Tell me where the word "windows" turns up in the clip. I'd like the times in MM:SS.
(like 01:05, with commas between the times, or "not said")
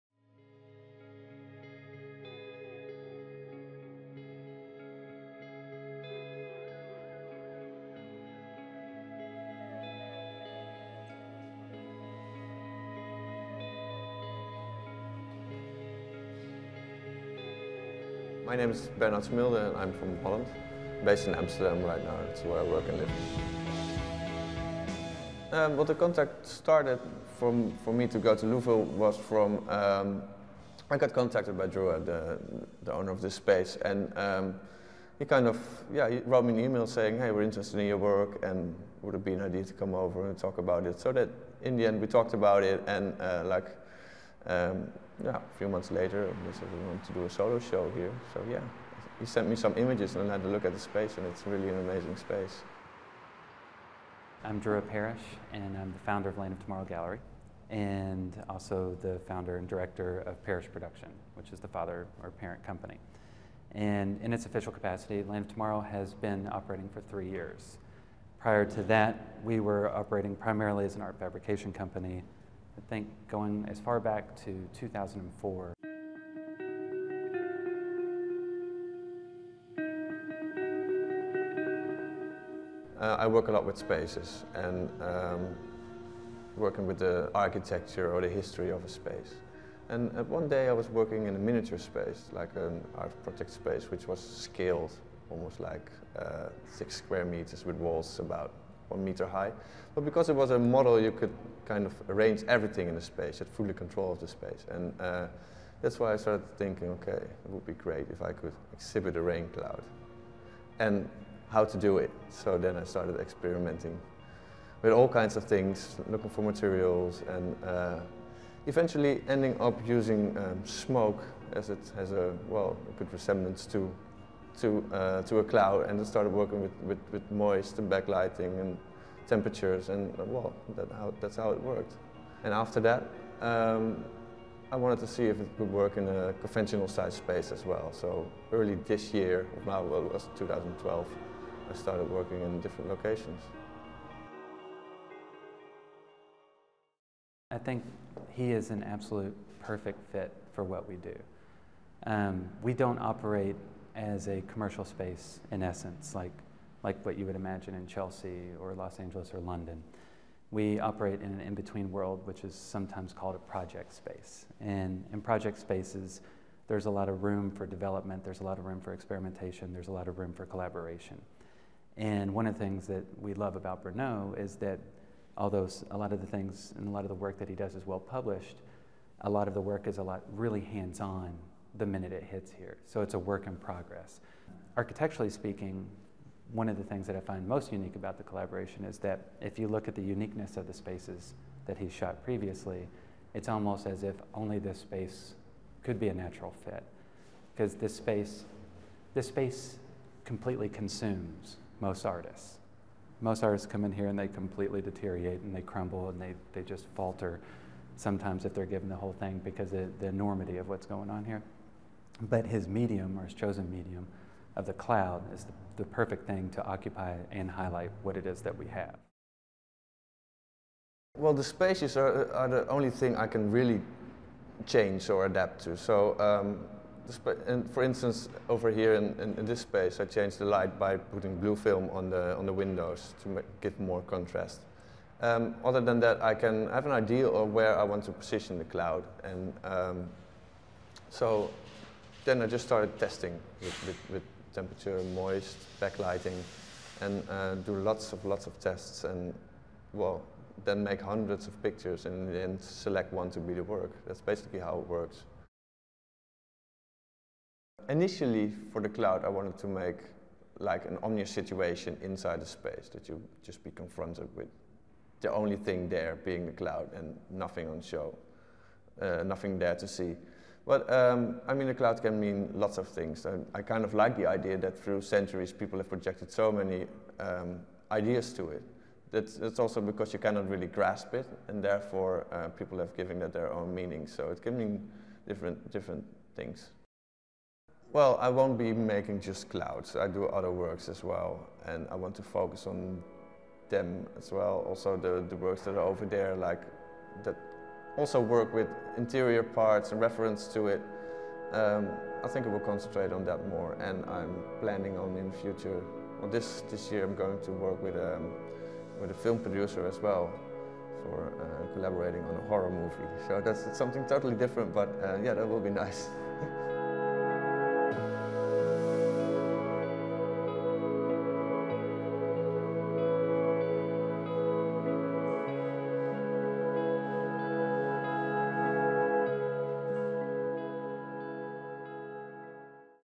03:52.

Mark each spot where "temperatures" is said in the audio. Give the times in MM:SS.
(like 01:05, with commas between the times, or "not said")
02:09, 04:04.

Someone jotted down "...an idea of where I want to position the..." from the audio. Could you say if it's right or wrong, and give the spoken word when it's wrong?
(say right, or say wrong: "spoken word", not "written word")
right.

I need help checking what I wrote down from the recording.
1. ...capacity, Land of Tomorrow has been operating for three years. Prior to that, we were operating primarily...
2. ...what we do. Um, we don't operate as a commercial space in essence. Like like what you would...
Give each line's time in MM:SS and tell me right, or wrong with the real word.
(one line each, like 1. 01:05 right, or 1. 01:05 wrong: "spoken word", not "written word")
1. 01:04 right
2. 02:30 right.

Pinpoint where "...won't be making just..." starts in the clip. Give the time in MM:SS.
04:48.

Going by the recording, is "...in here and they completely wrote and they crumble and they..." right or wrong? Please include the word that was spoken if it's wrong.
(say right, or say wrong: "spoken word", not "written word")
wrong: "deteriorate", not "wrote".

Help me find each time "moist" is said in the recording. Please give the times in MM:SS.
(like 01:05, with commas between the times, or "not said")
02:07, 04:05.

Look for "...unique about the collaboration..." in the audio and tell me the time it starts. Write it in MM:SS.
03:07.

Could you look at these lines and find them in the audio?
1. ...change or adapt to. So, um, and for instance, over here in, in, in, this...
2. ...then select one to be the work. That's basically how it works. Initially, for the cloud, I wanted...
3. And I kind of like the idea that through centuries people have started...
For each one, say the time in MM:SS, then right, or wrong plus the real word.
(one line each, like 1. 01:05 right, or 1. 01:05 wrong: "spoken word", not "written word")
1. 03:44 right
2. 04:12 right
3. 04:33 wrong: "projected", not "started".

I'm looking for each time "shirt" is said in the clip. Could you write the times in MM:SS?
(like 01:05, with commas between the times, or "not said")
not said.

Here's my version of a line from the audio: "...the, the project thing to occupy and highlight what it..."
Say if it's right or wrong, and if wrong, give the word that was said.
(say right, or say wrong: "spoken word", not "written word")
wrong: "perfect", not "project".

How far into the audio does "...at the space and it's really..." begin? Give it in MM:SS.
00:50.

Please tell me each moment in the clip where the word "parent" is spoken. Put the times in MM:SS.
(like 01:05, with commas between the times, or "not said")
01:02.